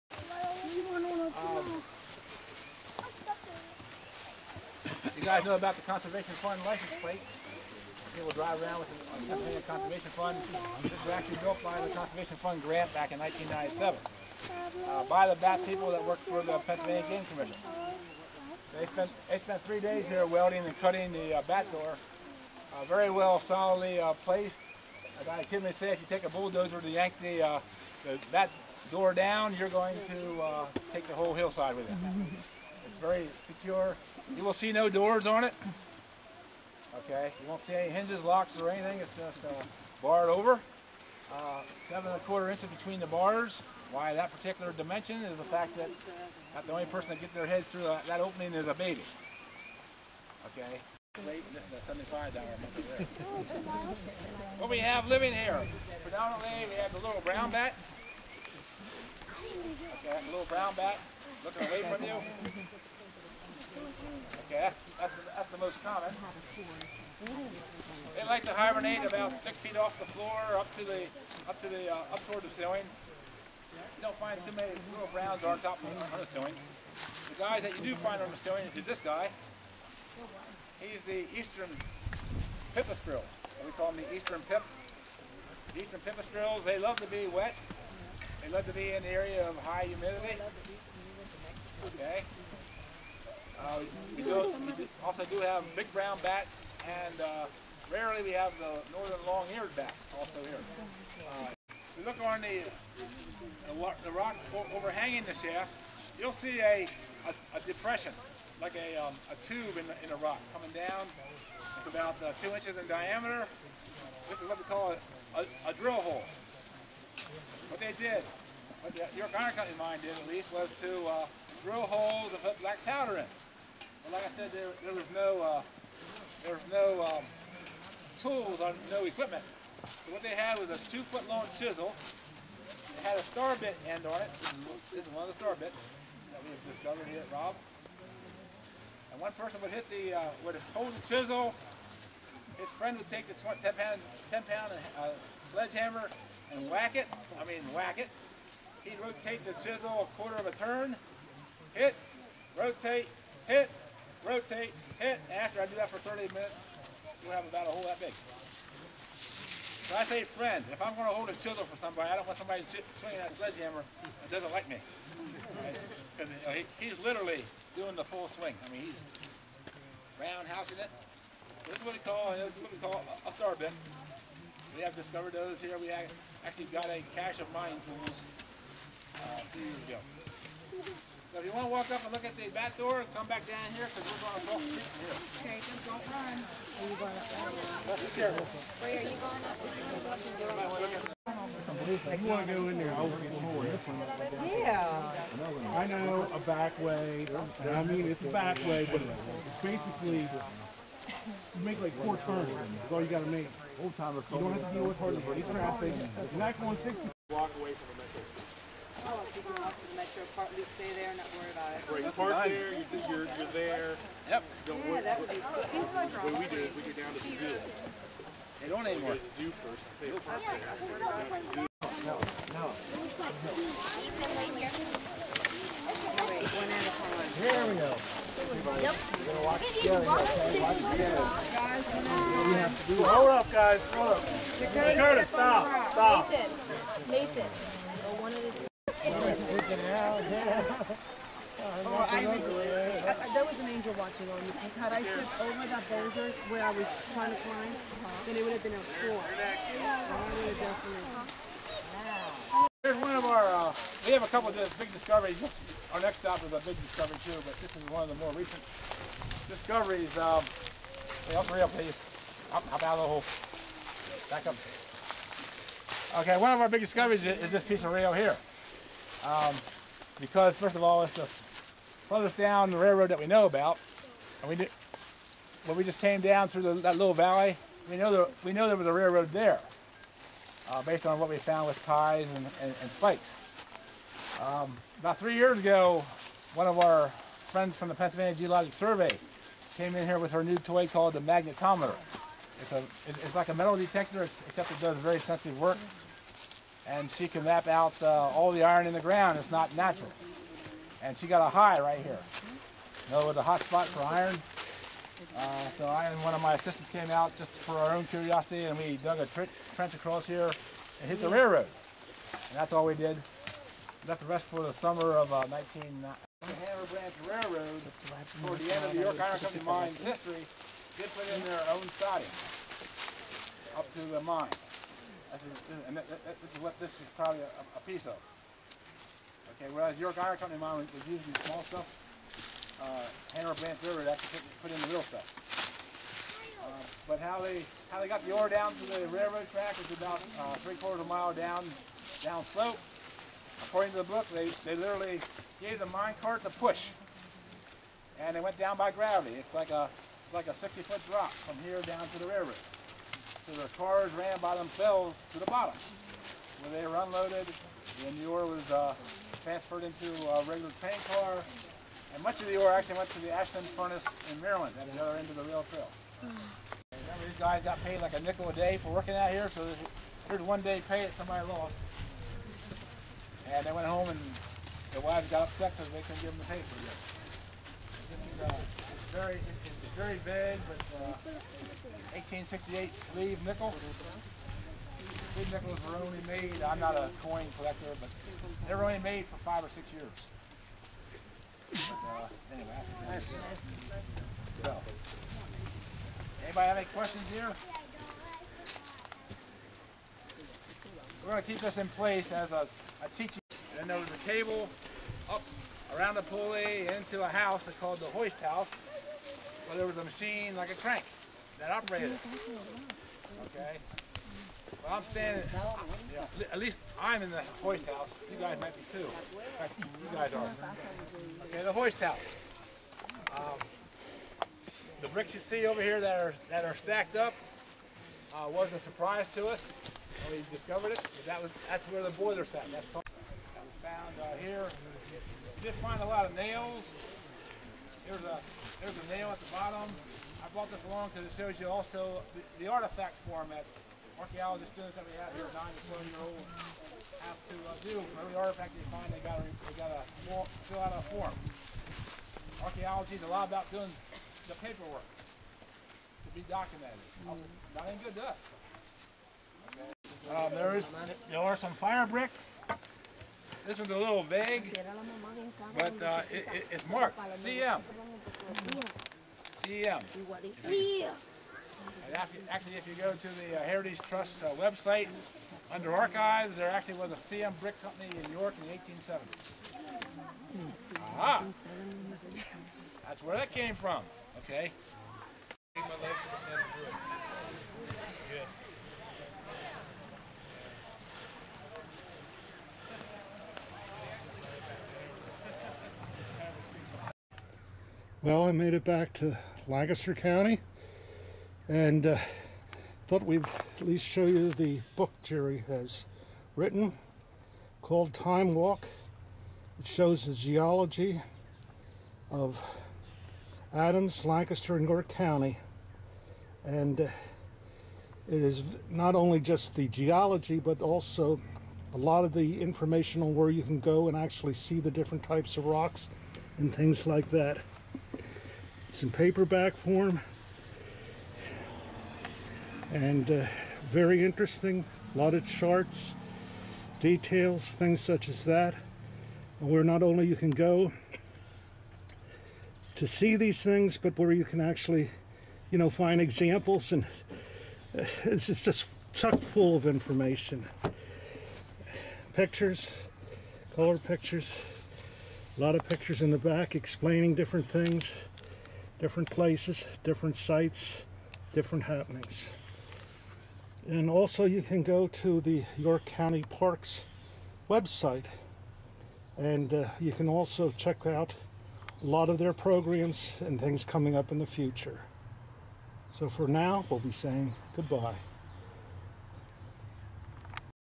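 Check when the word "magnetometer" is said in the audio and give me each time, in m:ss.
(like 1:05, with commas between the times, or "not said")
4:51.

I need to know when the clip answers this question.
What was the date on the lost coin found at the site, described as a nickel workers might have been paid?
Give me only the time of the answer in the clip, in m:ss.
6:22.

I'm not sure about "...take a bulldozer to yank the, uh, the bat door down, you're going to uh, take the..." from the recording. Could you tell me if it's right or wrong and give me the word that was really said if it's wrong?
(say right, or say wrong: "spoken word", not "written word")
right.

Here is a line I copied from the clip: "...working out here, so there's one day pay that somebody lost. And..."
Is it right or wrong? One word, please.
right.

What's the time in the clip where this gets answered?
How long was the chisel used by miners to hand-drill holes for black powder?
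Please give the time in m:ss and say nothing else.
2:10.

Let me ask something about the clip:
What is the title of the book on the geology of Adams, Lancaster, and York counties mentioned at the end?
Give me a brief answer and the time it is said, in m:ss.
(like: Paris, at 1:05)
Time Walk, at 8:28.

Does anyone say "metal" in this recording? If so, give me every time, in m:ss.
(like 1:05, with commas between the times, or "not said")
4:53.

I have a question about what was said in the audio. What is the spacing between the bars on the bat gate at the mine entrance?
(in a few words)
7 1/4 inches.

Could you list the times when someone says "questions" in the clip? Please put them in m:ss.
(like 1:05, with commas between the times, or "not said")
6:36.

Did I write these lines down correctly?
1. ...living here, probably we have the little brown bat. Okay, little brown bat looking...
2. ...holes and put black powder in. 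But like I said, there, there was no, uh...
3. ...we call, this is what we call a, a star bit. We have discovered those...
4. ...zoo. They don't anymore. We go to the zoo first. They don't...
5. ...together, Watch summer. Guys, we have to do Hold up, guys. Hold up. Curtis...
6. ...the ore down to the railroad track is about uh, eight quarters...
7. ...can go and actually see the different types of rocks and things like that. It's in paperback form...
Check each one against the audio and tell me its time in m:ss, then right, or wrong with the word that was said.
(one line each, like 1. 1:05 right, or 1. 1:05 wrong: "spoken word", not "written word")
1. 0:55 wrong: "predominantly", not "probably"
2. 2:01 right
3. 2:51 right
4. 3:37 right
5. 3:49 wrong: "together", not "summer"
6. 5:38 wrong: "three", not "eight"
7. 8:43 right.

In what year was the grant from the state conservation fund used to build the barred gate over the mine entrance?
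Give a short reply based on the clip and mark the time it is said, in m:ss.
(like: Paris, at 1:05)
1997, at 0:13.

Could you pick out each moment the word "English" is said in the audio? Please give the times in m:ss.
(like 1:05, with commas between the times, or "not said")
not said.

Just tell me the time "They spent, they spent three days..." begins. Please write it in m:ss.
0:18.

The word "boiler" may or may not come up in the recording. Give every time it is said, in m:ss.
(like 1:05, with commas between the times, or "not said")
7:12.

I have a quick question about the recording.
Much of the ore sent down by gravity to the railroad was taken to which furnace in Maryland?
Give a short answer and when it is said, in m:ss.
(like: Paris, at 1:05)
Ashland furnace, at 6:03.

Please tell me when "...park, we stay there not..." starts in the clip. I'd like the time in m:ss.
3:30.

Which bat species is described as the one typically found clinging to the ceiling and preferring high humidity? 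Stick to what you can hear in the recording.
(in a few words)
Eastern pipistrelle.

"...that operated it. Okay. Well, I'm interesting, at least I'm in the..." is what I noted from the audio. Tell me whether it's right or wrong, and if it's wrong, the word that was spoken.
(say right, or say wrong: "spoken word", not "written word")
wrong: "saying", not "interesting".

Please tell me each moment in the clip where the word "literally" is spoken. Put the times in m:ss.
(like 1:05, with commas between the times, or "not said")
2:47, 5:44.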